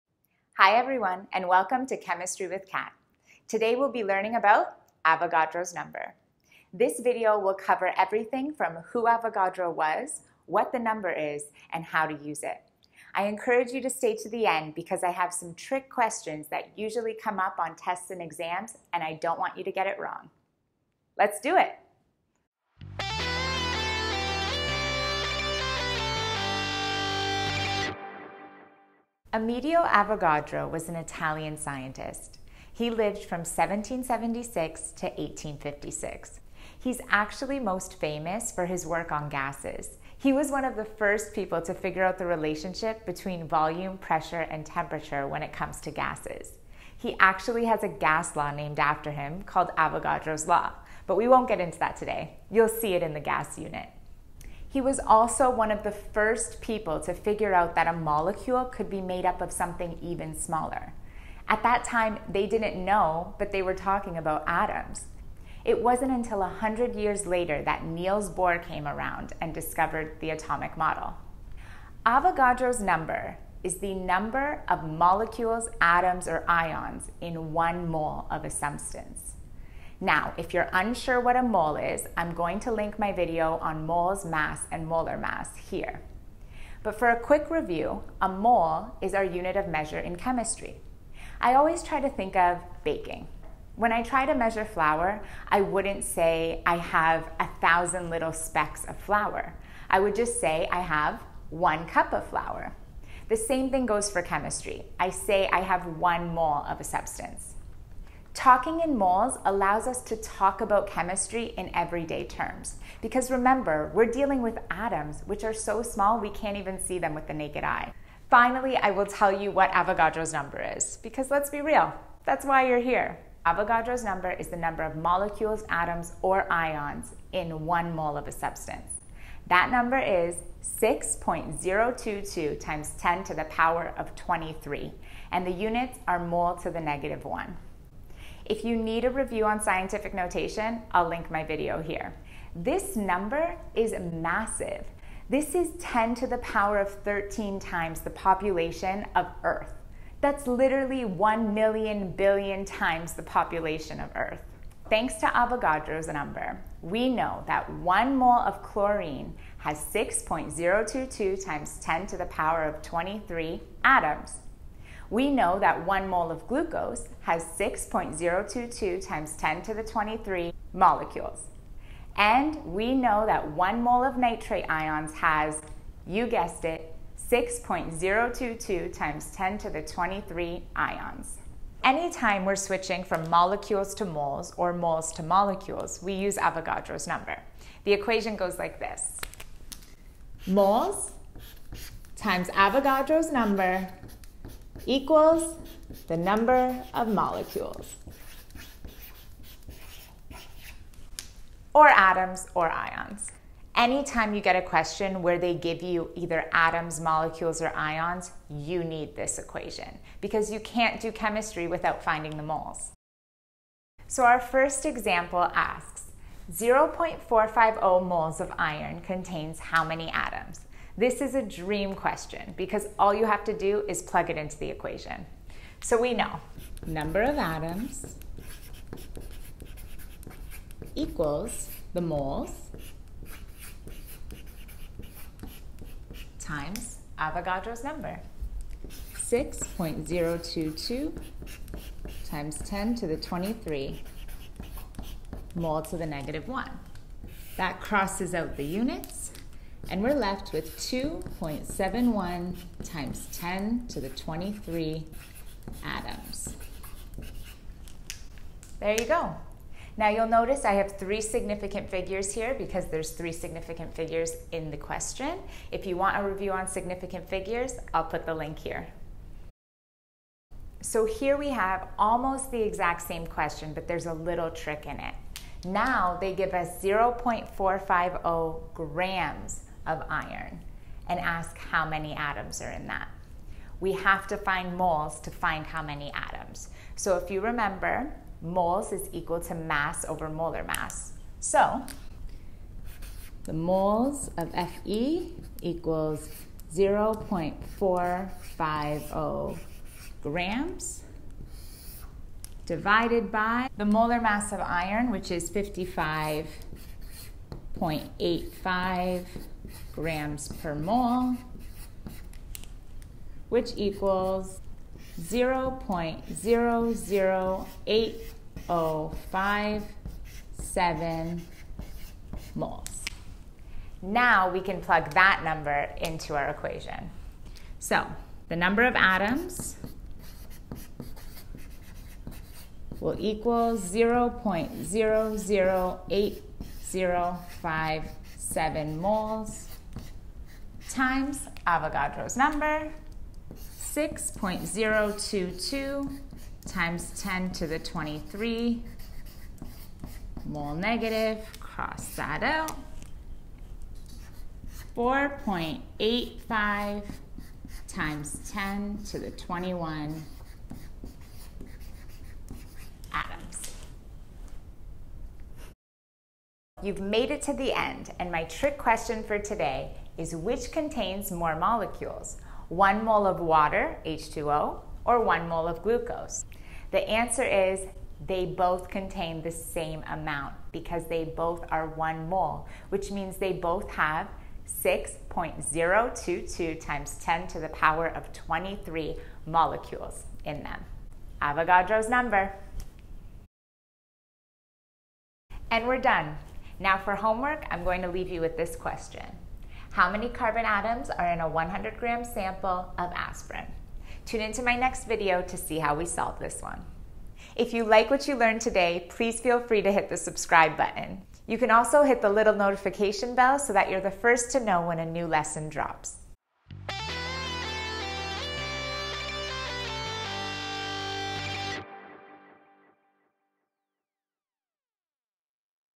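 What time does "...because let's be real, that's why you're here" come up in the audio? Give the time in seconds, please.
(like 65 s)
121 s.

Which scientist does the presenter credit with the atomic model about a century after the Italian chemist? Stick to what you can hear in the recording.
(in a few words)
Niels Bohr.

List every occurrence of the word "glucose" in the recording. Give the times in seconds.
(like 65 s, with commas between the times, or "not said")
166 s, 375 s.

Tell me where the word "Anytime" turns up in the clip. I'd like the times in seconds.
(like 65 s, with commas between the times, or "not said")
181 s, 203 s.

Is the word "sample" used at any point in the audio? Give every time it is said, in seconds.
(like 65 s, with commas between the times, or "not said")
402 s.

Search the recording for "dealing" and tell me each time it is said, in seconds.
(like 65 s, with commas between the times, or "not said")
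114 s.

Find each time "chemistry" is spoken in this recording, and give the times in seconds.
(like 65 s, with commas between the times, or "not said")
1 s, 90 s, 104 s, 110 s, 211 s.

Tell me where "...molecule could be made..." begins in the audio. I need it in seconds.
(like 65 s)
57 s.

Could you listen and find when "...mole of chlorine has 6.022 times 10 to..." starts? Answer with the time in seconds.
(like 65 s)
158 s.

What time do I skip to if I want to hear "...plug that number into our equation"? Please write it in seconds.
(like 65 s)
324 s.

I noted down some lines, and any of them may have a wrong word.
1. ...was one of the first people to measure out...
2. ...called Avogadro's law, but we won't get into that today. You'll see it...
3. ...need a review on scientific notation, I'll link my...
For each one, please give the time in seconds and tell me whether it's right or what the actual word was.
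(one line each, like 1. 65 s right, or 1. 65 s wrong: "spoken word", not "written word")
1. 40 s wrong: "figure", not "measure"
2. 49 s right
3. 138 s right.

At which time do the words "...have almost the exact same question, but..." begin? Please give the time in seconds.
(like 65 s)
271 s.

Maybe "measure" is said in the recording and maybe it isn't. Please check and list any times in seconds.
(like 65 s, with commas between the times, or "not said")
89 s, 94 s.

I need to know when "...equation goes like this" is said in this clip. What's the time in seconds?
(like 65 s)
187 s.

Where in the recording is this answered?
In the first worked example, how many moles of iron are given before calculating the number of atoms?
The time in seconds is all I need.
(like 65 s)
216 s.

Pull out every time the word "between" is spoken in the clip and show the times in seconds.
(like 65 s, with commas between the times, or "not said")
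43 s.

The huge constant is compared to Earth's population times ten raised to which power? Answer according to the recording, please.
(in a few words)
13.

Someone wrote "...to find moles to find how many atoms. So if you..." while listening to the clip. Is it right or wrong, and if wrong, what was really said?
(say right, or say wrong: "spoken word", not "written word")
right.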